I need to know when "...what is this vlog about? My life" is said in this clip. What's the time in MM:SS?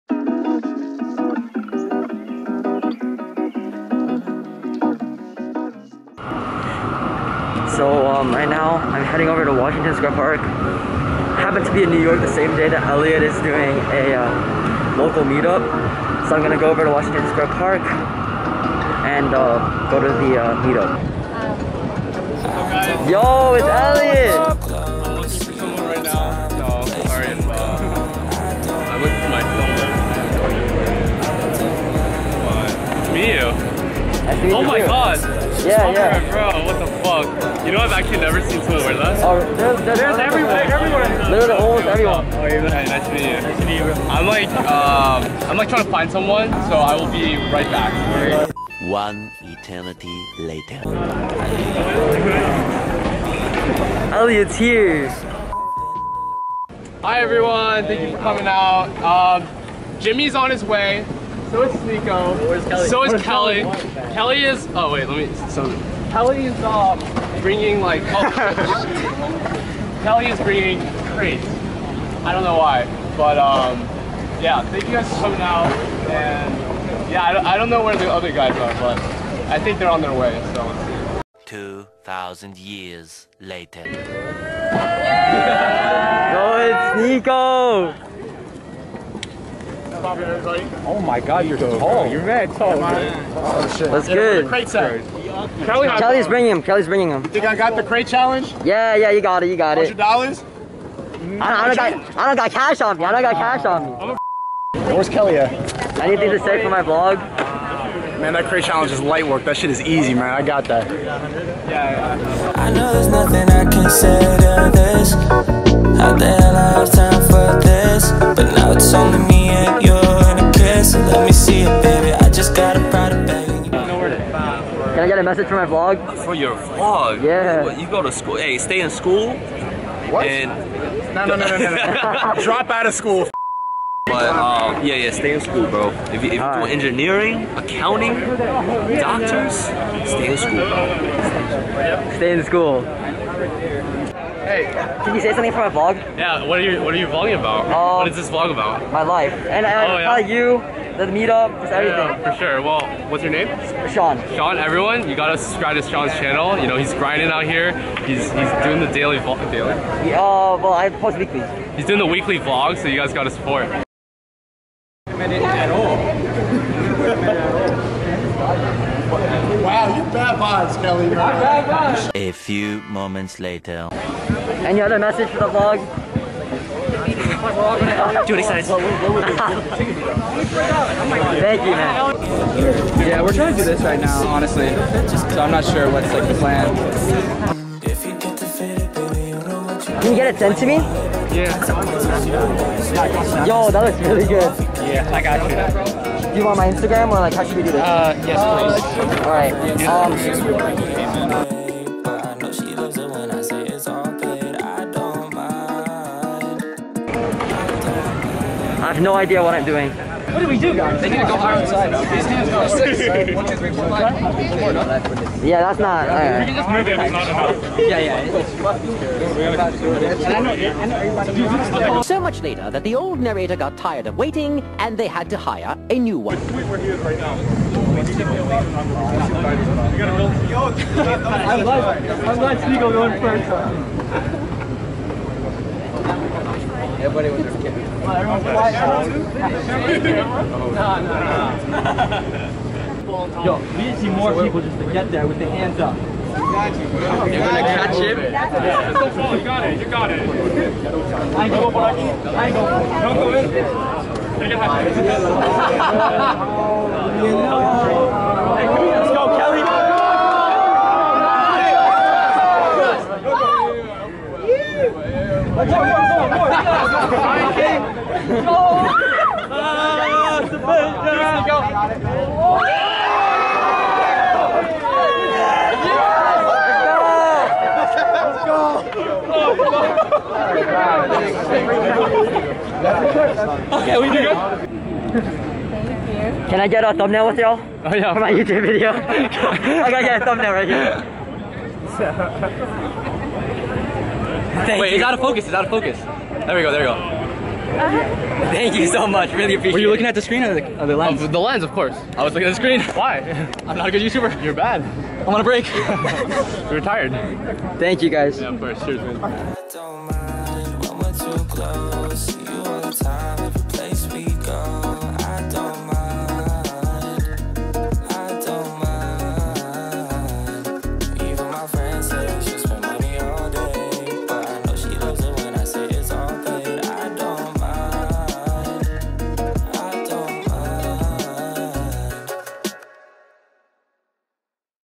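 02:27.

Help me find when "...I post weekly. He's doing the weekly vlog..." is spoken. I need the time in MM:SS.
02:40.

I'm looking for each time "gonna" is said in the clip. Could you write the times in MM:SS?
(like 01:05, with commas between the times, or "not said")
00:16, 04:06.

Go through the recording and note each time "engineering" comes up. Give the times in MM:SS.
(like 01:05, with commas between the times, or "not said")
02:16.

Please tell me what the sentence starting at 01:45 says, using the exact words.
Anything to say for my vlog?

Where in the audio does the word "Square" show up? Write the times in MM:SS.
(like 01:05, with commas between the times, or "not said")
00:09, 00:17.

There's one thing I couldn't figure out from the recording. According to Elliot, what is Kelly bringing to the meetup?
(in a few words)
Crates.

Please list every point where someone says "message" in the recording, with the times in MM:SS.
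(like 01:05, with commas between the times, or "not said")
02:05, 02:54.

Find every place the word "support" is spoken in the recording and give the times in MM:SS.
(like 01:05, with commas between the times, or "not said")
02:43.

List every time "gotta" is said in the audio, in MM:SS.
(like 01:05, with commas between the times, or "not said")
02:35, 02:43.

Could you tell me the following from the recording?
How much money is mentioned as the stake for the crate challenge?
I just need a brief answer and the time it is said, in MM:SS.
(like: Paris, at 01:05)
$100, at 01:40.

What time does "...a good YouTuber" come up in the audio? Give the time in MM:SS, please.
05:03.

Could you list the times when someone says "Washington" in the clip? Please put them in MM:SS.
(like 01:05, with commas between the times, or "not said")
00:09, 00:16.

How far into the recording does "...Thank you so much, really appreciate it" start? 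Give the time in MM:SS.
04:58.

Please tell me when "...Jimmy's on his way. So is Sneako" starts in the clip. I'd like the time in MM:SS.
00:59.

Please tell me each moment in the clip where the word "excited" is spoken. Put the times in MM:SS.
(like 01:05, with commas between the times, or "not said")
02:58.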